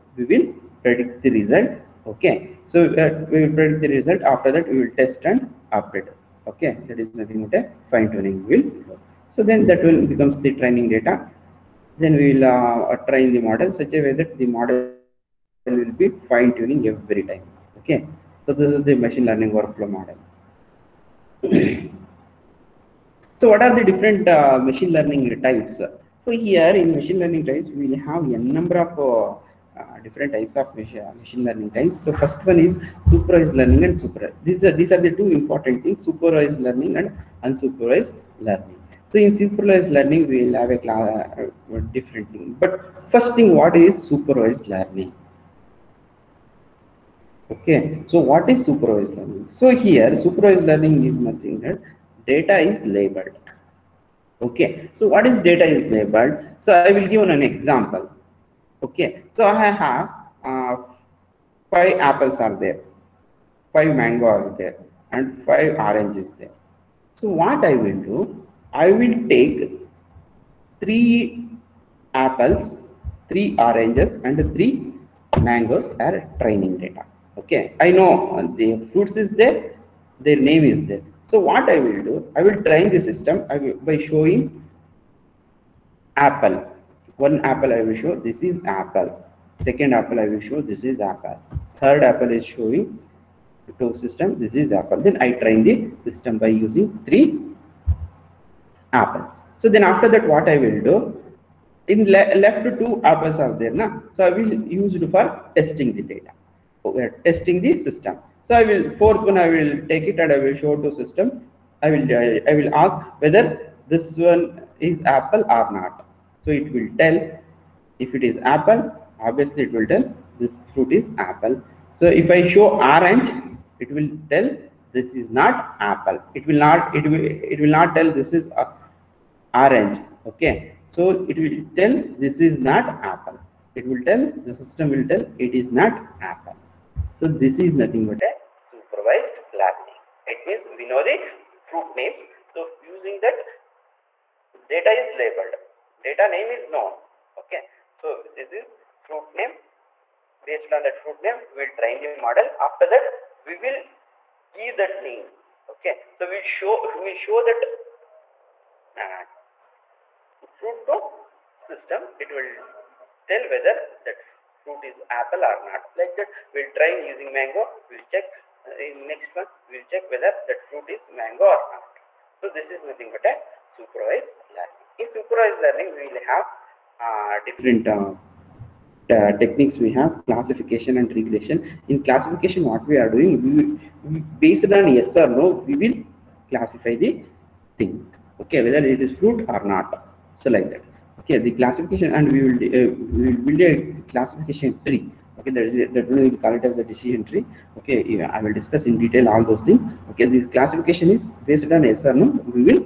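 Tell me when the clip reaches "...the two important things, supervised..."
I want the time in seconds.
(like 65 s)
34 s.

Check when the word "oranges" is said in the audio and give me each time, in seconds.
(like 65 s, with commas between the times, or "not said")
65 s, 73 s, 122 s, 129 s.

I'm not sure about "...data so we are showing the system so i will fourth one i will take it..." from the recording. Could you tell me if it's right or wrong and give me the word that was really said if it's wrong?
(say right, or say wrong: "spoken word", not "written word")
wrong: "testing", not "showing".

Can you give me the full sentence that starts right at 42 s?
But first thing, what is supervised learning?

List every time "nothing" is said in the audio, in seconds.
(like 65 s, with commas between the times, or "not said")
7 s, 51 s, 137 s, 172 s.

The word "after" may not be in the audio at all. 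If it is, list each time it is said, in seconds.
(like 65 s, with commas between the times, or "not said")
4 s, 99 s, 152 s.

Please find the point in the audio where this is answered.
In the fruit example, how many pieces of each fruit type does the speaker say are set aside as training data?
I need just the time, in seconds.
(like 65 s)
70 s.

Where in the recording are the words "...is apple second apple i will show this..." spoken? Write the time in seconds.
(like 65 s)
88 s.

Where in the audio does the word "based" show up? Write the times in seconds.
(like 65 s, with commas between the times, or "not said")
150 s, 184 s, 201 s.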